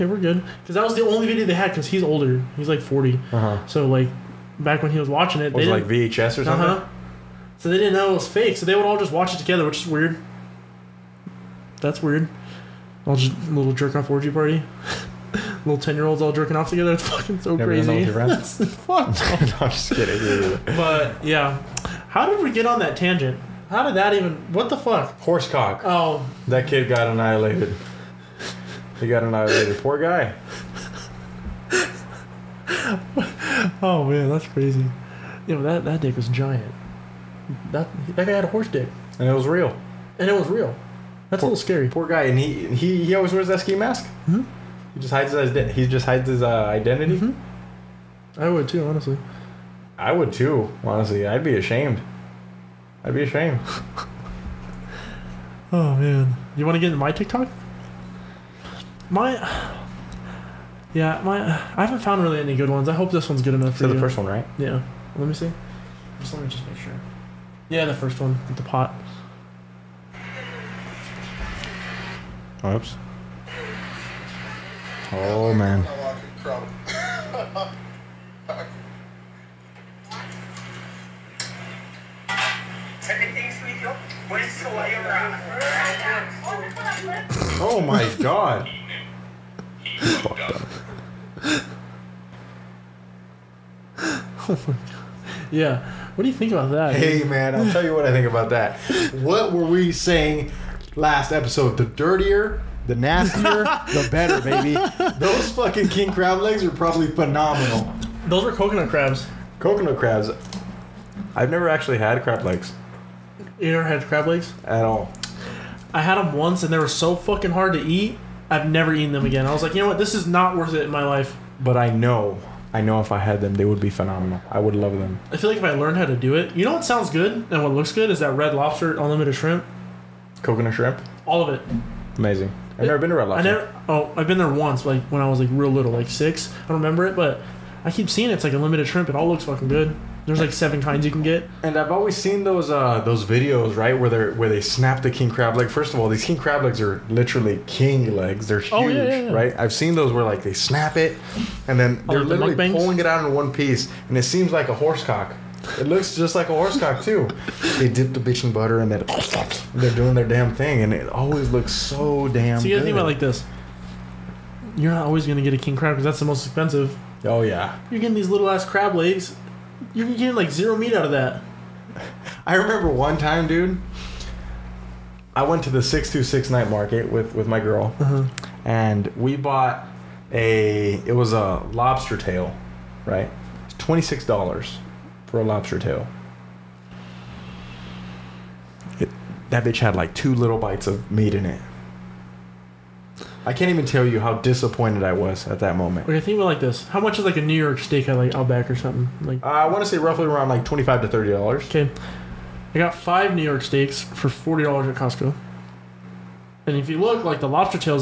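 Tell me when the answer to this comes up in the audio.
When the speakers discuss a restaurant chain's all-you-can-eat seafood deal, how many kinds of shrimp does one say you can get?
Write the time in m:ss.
2:20.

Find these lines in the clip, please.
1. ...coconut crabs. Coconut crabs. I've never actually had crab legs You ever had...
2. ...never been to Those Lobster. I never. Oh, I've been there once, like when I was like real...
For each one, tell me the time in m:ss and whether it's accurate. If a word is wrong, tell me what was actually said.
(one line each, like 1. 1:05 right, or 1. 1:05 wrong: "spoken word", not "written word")
1. 1:48 right
2. 2:12 wrong: "Red", not "Those".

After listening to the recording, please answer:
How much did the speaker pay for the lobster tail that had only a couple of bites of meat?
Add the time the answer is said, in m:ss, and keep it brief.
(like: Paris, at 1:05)
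$26, at 3:03.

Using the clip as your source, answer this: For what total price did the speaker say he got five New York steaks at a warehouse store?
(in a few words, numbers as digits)
$40.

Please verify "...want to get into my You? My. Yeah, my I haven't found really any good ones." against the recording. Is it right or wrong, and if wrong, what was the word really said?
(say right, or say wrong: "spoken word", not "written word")
wrong: "TikTok", not "You".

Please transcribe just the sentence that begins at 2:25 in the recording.
First of all, these king crab legs are literally king legs.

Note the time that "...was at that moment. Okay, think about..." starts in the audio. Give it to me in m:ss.
3:15.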